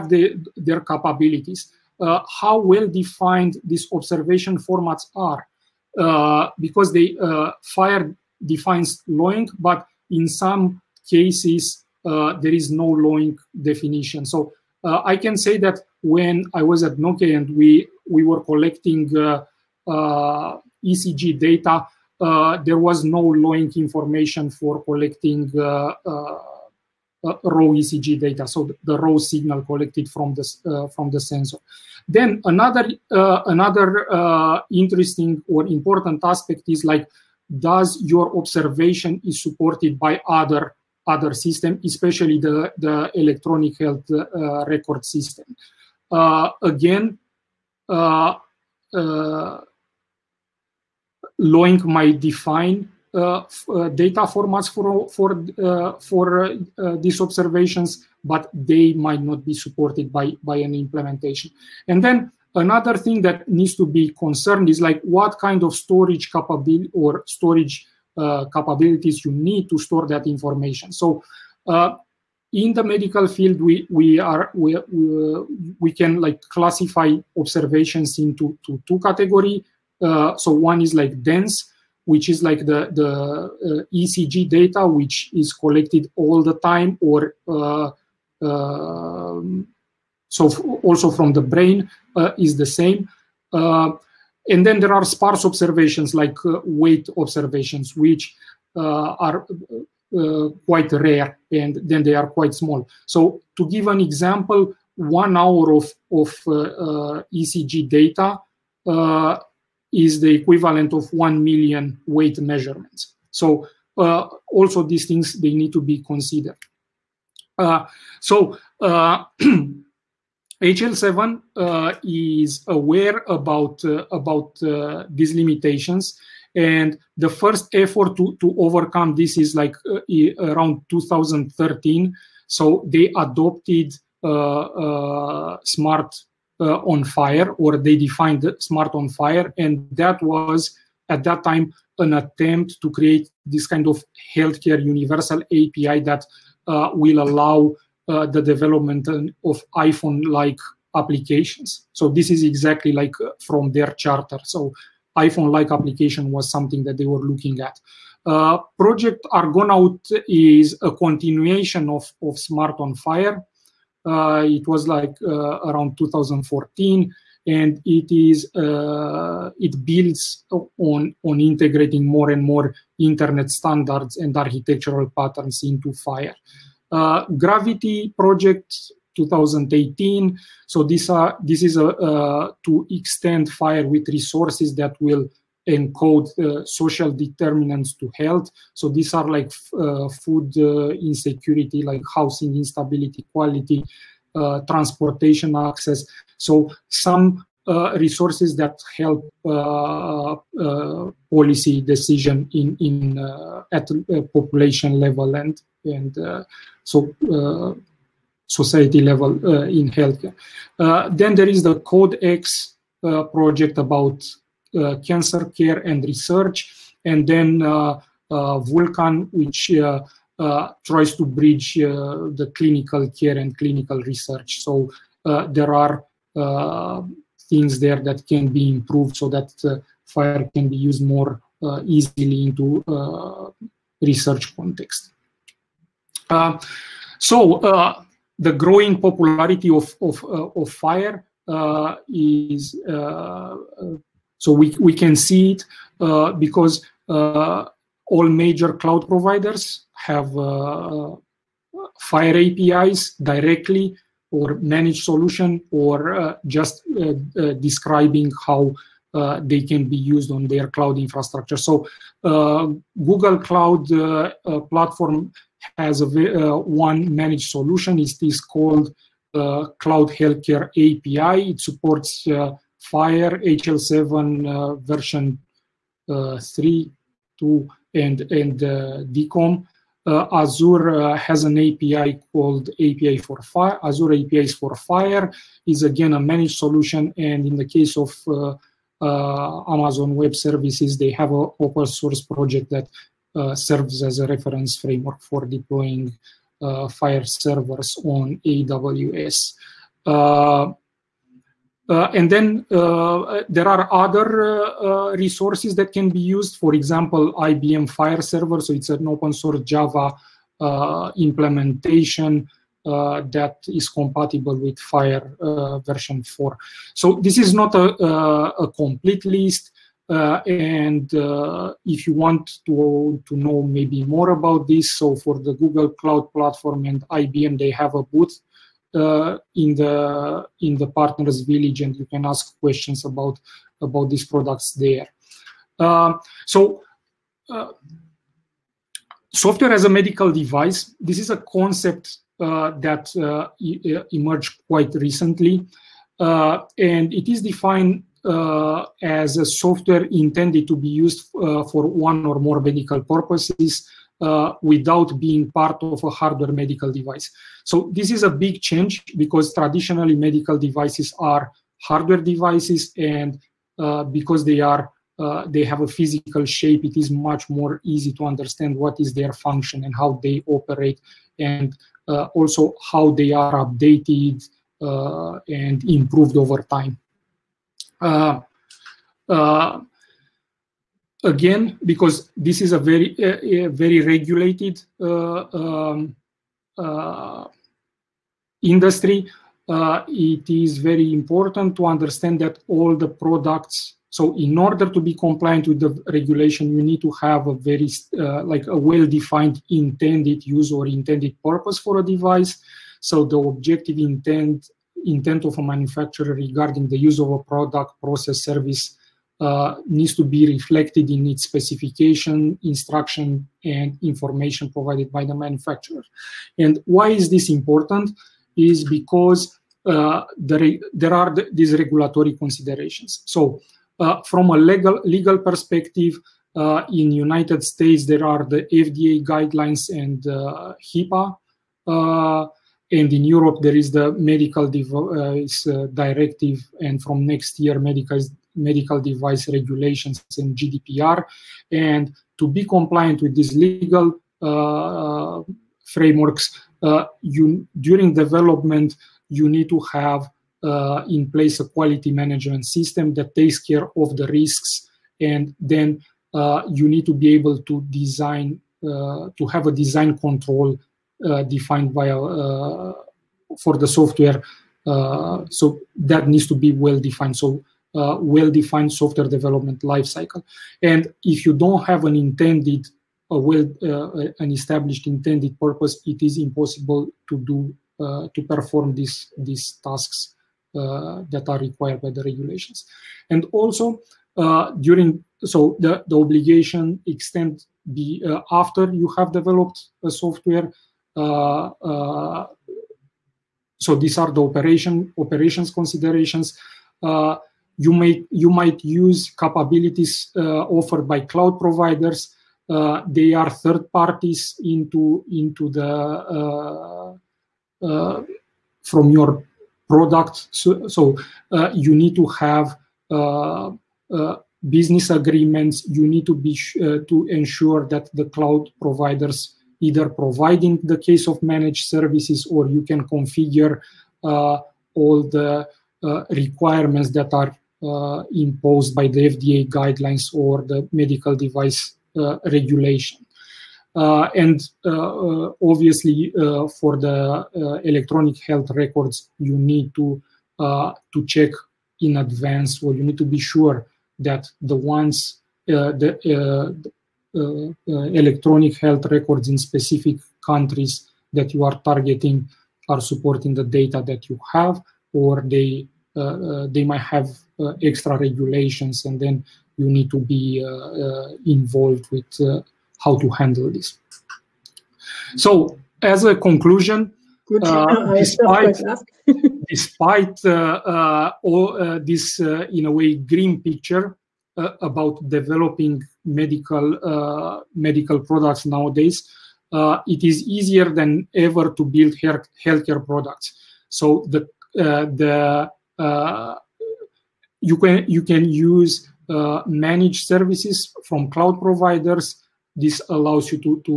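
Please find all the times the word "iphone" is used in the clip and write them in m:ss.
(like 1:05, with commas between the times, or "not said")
2:29, 2:35.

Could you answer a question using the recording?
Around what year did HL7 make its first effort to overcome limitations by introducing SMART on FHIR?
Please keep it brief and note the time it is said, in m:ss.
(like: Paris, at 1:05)
2013, at 2:10.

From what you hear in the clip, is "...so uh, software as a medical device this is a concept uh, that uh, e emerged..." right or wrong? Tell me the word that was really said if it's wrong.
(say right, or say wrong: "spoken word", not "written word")
right.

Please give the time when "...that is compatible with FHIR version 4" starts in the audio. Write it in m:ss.
5:13.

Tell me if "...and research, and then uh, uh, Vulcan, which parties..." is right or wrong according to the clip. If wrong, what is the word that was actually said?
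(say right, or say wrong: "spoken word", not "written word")
wrong: "tries", not "parties".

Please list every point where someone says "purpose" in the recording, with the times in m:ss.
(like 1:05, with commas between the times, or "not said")
5:53, 6:41, 7:55.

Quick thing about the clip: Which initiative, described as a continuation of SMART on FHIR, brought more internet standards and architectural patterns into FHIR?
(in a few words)
Project Argonaut.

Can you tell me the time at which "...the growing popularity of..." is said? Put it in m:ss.
3:58.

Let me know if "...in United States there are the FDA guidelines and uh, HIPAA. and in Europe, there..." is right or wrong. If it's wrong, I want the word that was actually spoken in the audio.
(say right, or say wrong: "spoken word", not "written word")
right.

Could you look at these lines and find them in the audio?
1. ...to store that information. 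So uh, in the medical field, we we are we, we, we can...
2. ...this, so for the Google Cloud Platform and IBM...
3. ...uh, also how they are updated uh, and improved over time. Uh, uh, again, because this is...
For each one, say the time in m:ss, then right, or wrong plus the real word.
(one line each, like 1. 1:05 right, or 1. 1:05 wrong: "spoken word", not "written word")
1. 1:09 right
2. 5:24 right
3. 6:12 right.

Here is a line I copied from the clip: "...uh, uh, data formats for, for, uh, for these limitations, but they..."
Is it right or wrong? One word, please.
wrong.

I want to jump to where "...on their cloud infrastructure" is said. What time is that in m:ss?
4:20.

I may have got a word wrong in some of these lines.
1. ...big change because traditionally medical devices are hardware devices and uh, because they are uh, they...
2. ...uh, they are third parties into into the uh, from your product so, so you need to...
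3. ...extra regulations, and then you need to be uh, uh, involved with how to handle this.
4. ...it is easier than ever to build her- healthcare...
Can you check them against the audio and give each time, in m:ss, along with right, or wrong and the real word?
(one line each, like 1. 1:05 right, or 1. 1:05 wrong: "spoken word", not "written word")
1. 5:58 right
2. 8:22 right
3. 9:17 right
4. 9:40 right.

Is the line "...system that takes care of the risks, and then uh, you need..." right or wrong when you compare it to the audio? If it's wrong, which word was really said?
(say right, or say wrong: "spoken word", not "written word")
right.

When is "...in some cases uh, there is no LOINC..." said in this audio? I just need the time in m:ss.
0:10.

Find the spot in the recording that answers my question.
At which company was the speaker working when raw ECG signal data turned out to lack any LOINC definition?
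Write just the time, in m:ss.
0:16.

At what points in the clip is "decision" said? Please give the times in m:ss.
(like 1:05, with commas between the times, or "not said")
3:21.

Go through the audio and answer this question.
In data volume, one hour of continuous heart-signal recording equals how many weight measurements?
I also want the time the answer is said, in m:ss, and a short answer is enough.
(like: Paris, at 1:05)
1 million, at 1:51.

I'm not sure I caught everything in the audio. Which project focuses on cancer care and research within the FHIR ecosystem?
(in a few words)
CodeX.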